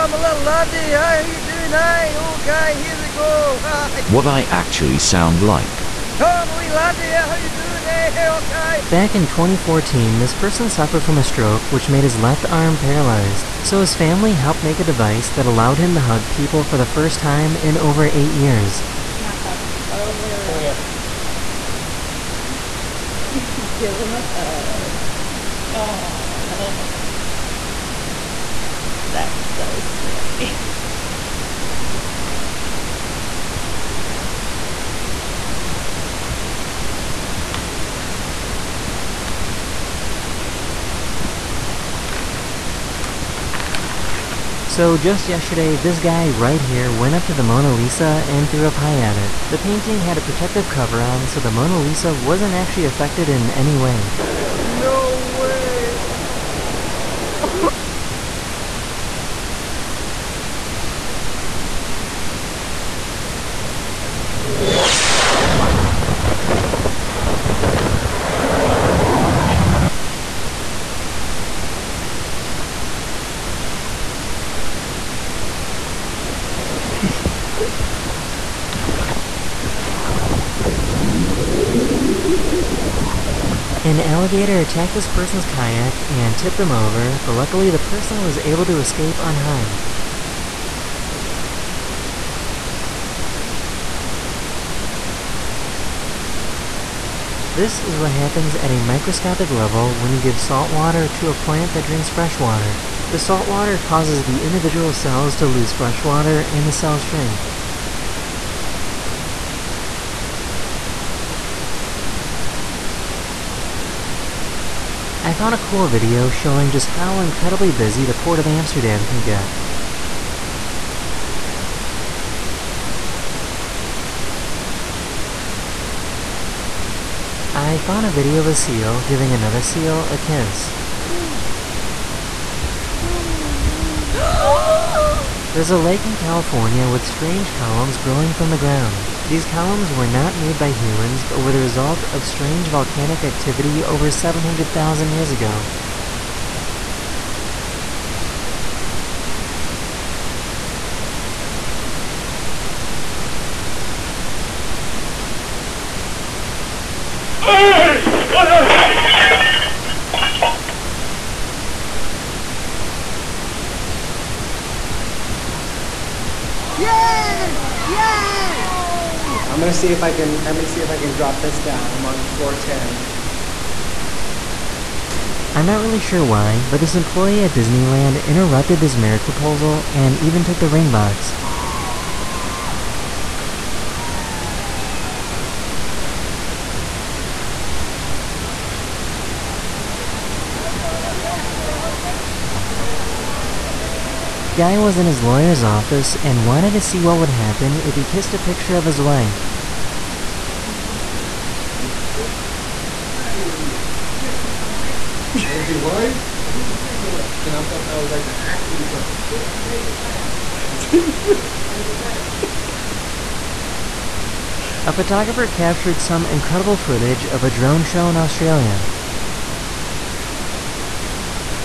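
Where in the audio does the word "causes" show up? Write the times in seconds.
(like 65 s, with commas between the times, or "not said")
103 s.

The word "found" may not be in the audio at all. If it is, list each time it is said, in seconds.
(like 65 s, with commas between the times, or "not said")
115 s, 127 s.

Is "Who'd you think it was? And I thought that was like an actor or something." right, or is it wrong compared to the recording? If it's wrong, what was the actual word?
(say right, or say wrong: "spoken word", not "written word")
right.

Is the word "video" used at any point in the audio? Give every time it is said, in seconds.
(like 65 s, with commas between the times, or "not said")
115 s, 128 s.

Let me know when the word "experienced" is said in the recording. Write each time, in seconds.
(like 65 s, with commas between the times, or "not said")
not said.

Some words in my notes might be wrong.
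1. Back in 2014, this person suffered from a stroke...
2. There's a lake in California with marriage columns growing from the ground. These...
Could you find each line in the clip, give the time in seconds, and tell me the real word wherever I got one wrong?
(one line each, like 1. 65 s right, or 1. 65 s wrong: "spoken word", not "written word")
1. 8 s right
2. 135 s wrong: "strange", not "marriage".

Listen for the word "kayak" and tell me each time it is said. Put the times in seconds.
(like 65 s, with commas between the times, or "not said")
85 s.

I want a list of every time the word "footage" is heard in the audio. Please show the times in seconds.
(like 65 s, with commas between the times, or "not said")
216 s.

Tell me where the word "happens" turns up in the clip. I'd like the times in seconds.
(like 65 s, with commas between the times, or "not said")
98 s, 197 s.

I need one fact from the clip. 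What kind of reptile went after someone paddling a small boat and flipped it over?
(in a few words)
Alligator.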